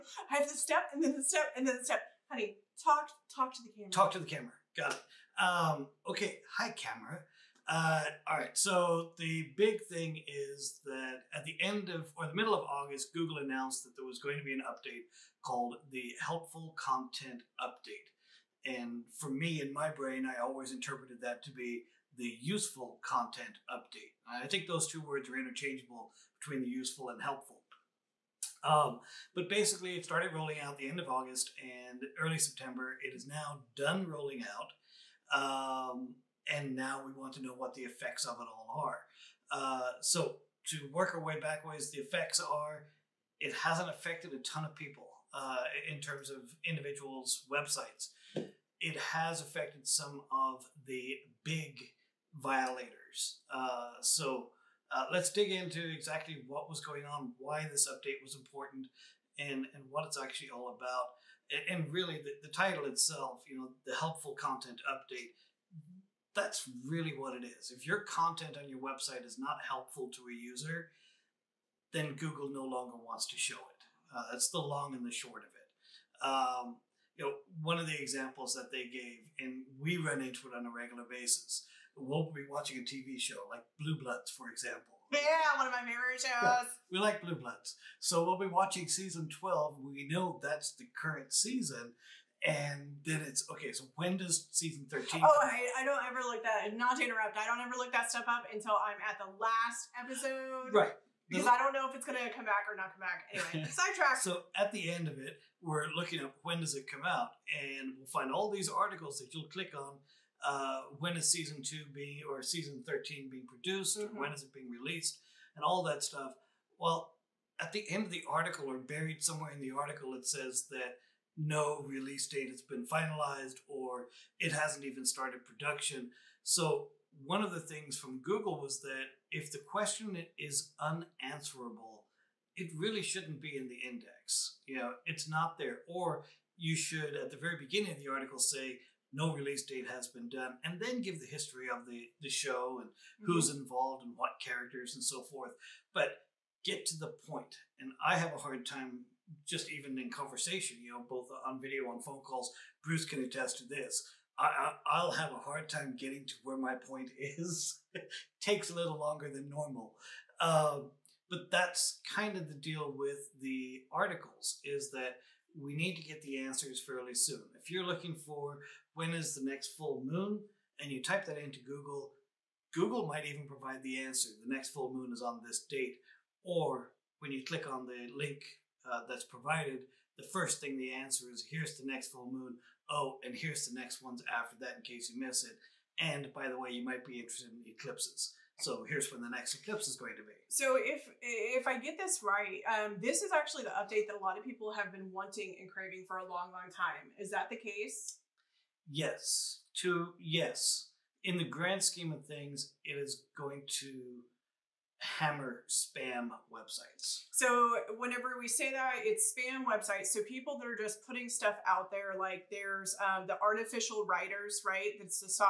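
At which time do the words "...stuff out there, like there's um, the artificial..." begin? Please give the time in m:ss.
3:31.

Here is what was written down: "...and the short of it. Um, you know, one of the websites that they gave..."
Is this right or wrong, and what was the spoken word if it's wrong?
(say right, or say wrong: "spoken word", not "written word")
wrong: "examples", not "websites".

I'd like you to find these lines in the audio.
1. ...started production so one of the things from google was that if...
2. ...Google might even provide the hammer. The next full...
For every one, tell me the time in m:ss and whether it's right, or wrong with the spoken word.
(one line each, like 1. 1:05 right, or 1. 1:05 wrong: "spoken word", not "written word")
1. 2:05 right
2. 2:52 wrong: "answer", not "hammer".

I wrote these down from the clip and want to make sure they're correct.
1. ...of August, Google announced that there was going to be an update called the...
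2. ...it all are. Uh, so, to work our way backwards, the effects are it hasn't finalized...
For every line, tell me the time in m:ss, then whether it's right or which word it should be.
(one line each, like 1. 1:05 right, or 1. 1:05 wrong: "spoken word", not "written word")
1. 0:12 right
2. 0:38 wrong: "affected", not "finalized".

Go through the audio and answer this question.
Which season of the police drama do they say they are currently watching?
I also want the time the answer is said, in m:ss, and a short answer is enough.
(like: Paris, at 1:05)
12, at 1:28.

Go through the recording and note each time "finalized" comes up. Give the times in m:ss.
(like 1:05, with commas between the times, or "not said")
2:02.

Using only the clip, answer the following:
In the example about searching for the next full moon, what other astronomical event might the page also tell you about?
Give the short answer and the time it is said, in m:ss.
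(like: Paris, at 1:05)
eclipses, at 3:07.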